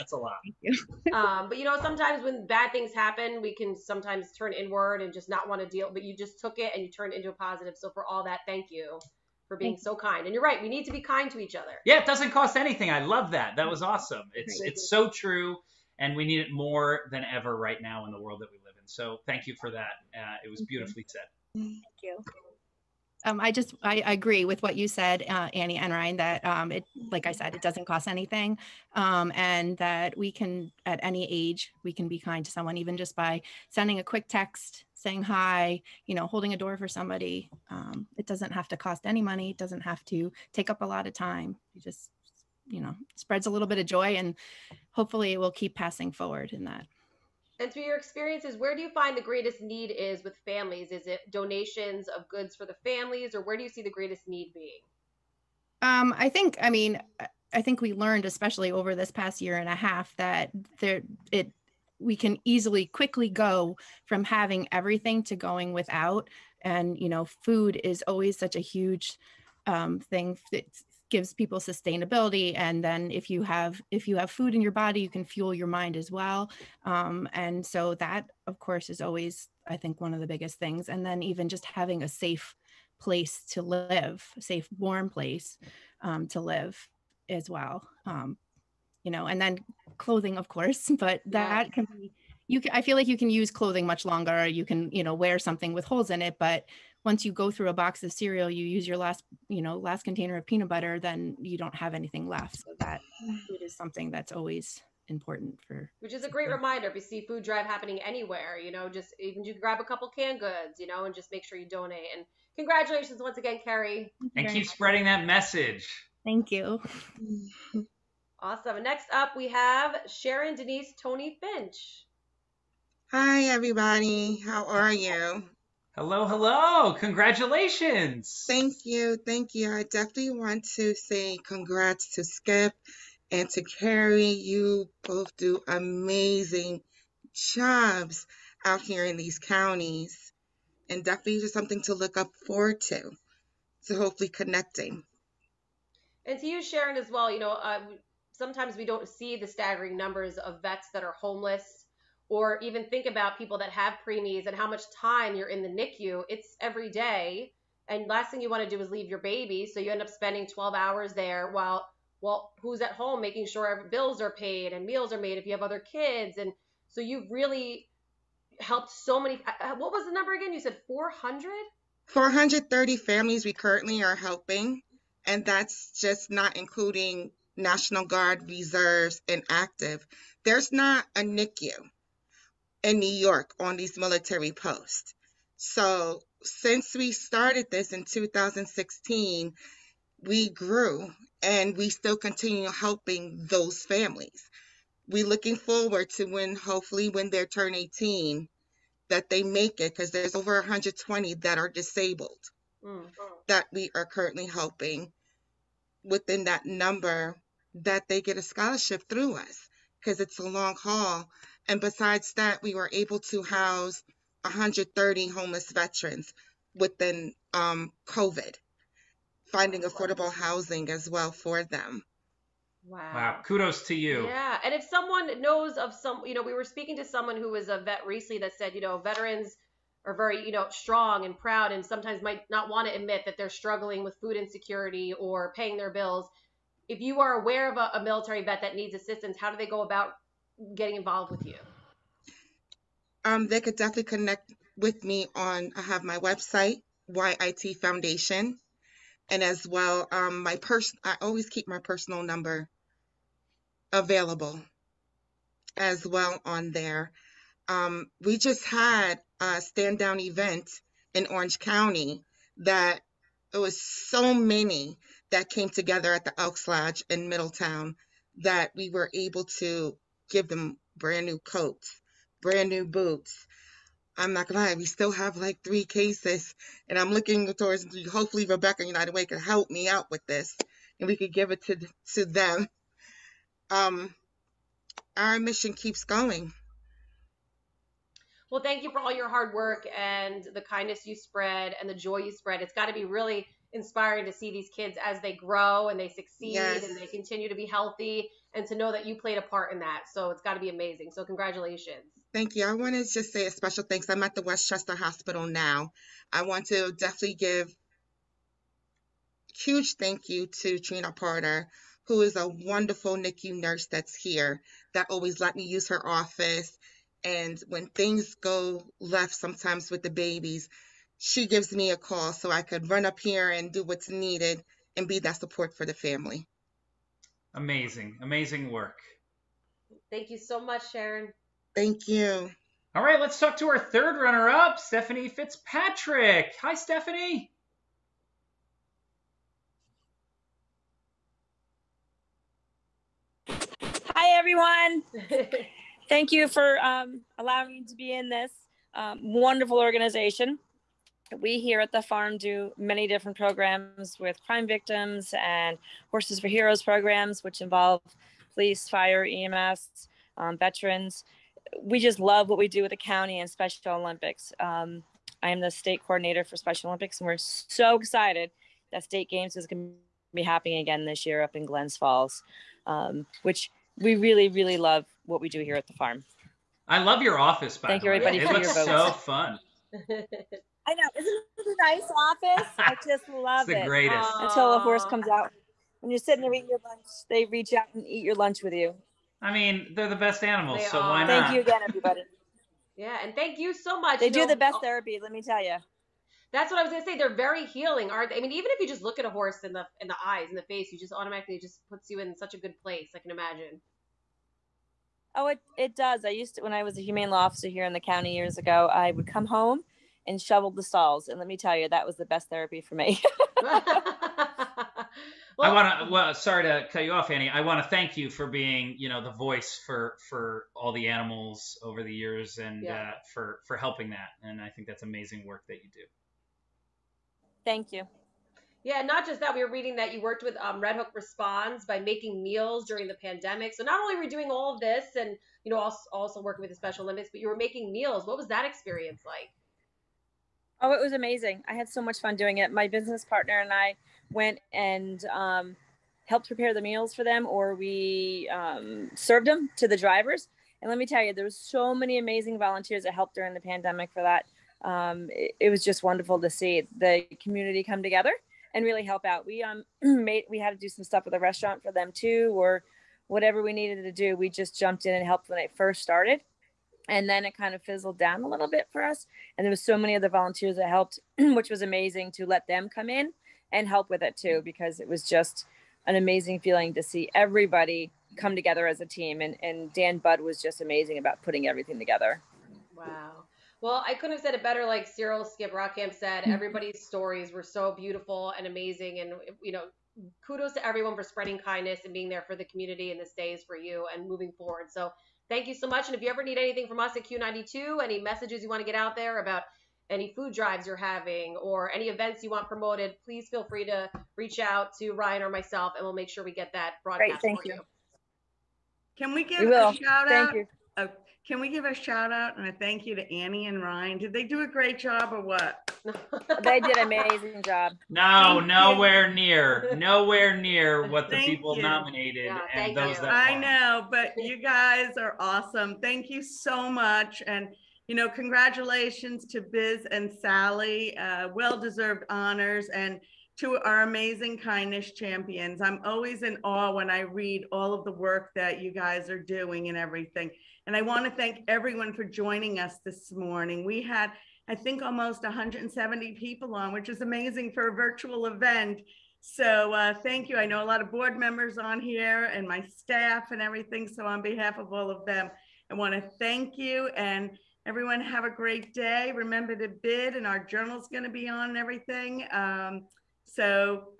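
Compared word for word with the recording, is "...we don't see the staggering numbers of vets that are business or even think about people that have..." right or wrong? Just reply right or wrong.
wrong.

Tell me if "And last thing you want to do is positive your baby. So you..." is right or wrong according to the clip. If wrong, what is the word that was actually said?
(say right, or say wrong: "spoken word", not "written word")
wrong: "leave", not "positive".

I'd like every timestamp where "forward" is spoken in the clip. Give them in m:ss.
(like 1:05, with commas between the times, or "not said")
0:46, 2:22, 3:15, 8:14.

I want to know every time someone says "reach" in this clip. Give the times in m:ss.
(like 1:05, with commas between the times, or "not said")
6:27, 8:24.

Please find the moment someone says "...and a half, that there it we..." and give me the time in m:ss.
0:59.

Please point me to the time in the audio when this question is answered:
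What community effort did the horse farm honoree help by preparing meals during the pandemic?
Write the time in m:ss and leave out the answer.
7:10.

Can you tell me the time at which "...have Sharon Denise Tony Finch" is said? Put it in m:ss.
1:59.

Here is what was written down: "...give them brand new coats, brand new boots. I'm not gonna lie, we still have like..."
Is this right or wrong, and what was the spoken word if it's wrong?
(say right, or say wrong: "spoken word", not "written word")
right.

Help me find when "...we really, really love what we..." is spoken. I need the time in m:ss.
6:14.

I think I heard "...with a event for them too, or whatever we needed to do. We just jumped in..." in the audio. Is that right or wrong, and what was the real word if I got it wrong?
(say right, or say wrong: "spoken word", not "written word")
wrong: "restaurant", not "event".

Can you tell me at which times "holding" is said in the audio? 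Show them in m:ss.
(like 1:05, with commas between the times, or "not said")
0:36.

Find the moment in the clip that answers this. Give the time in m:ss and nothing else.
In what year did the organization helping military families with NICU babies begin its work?
3:08.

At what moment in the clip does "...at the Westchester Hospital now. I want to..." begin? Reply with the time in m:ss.
5:04.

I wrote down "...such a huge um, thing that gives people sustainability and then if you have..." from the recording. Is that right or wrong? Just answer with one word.
right.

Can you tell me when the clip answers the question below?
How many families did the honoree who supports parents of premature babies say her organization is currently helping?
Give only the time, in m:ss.
2:52.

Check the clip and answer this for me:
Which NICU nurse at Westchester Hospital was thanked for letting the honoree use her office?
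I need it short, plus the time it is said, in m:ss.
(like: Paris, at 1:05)
Trina Porter, at 5:10.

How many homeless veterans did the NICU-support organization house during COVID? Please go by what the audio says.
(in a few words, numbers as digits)
130.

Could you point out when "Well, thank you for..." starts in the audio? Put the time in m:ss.
4:48.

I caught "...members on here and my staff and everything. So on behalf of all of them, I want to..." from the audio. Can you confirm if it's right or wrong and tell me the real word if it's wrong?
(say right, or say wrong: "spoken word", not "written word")
right.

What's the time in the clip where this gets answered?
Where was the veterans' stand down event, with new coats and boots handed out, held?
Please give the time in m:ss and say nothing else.
4:26.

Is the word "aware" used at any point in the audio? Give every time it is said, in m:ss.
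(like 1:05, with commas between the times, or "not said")
3:57.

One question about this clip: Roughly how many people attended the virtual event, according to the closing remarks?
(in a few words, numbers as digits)
almost 170.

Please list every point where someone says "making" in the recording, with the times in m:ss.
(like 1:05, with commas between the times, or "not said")
2:43, 7:11, 7:17.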